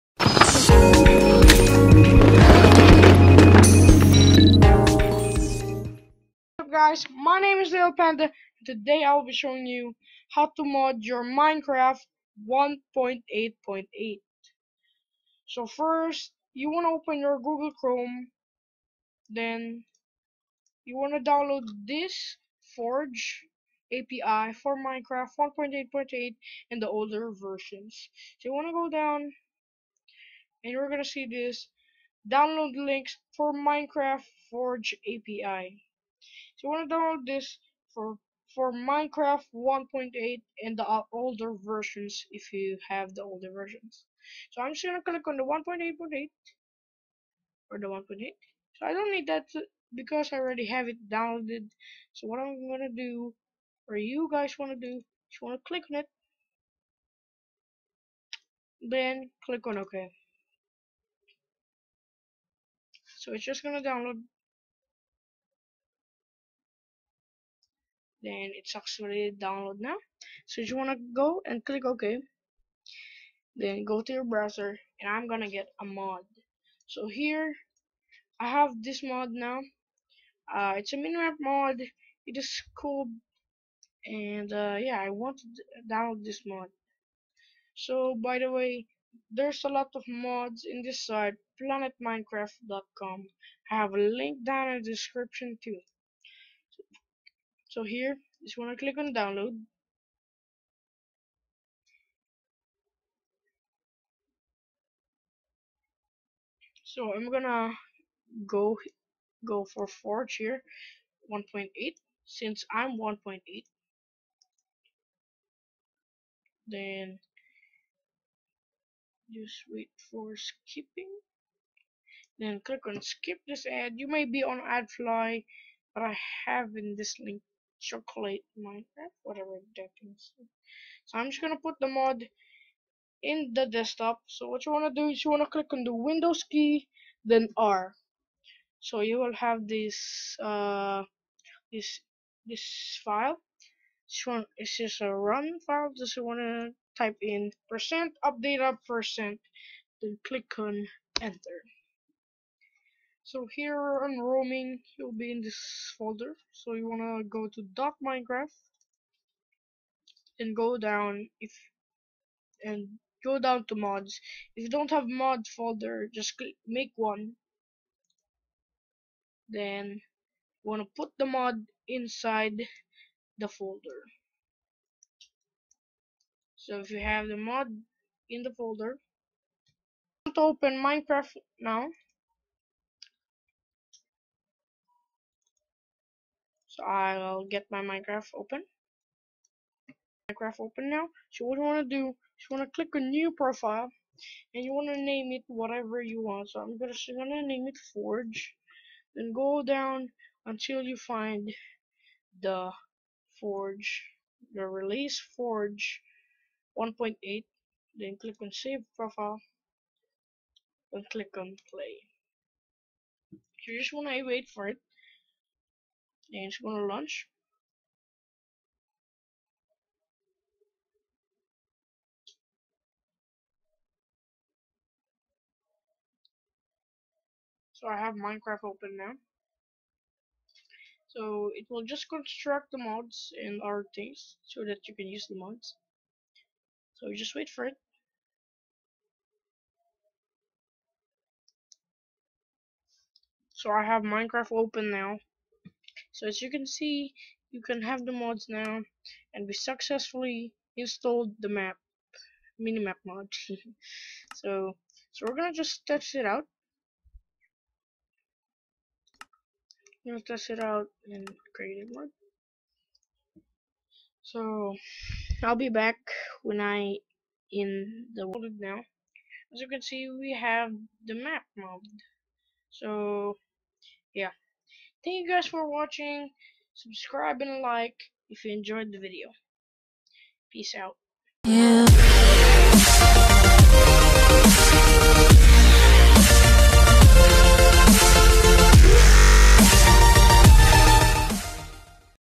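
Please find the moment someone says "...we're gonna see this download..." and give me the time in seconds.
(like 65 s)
30 s.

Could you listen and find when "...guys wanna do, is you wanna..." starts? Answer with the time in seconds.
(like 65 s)
54 s.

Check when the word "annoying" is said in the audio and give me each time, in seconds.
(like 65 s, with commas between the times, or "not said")
not said.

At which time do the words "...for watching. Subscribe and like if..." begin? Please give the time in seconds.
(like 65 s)
275 s.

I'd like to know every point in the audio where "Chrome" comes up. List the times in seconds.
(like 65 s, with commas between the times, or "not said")
17 s.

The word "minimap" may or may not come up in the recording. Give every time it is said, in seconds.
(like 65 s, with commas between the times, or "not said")
80 s, 252 s.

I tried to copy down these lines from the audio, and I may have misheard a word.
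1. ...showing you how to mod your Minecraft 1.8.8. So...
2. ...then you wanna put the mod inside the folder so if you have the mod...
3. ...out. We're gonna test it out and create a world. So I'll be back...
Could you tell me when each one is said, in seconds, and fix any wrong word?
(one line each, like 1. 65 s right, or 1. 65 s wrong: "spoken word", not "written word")
1. 9 s right
2. 169 s right
3. 256 s right.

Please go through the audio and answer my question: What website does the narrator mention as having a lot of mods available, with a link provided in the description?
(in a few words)
planetminecraft.com.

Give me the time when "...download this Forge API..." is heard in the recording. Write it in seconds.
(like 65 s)
21 s.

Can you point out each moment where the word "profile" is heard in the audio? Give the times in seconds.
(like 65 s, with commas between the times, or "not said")
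193 s, 208 s.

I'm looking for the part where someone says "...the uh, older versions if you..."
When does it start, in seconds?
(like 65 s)
40 s.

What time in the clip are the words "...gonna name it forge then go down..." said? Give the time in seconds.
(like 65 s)
197 s.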